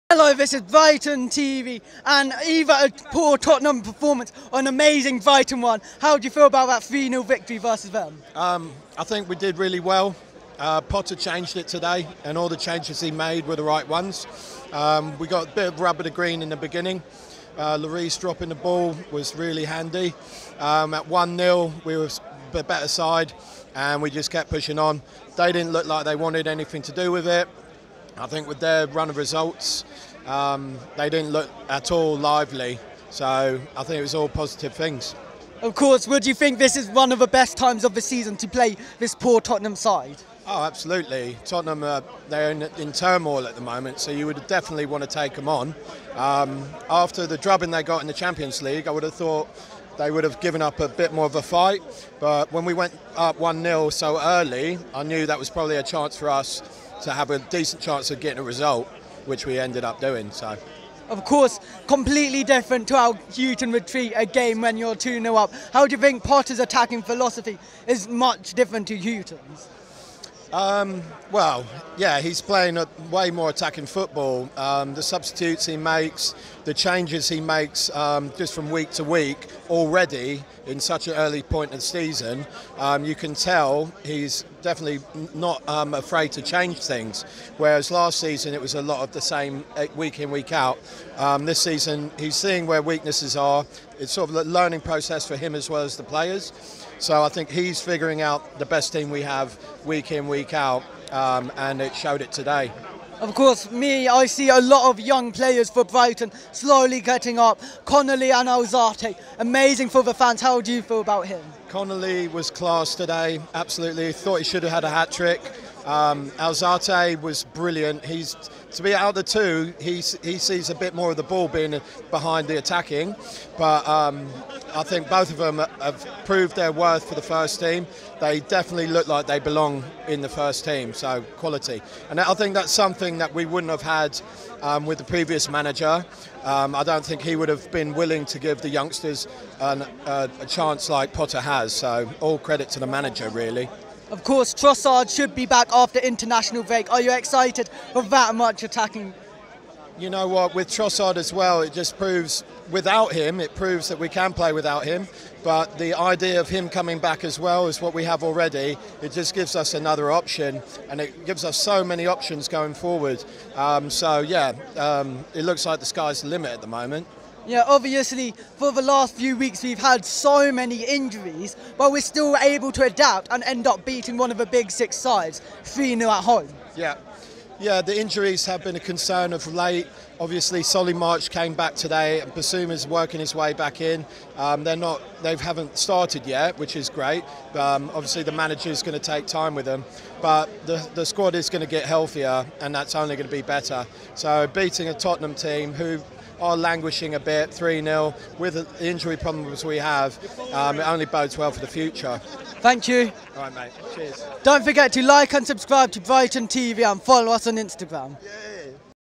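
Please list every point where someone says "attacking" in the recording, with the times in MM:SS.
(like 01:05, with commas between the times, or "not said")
01:06, 01:13, 02:02, 02:28.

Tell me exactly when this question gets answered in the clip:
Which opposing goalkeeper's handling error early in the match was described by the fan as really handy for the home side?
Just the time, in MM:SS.
00:17.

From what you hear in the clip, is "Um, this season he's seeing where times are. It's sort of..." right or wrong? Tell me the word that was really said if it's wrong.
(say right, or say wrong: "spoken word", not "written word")
wrong: "weaknesses", not "times".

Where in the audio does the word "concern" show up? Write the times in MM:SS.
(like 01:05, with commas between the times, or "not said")
02:58.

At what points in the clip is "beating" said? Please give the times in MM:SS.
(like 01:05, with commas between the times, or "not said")
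02:53, 03:14.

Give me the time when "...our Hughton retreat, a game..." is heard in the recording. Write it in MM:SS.
01:02.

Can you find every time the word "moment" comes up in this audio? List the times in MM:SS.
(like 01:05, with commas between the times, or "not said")
00:43, 02:46.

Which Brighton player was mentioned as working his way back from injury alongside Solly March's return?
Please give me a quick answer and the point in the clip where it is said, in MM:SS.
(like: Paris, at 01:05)
Bissouma, at 03:02.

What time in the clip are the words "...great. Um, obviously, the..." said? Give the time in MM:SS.
03:06.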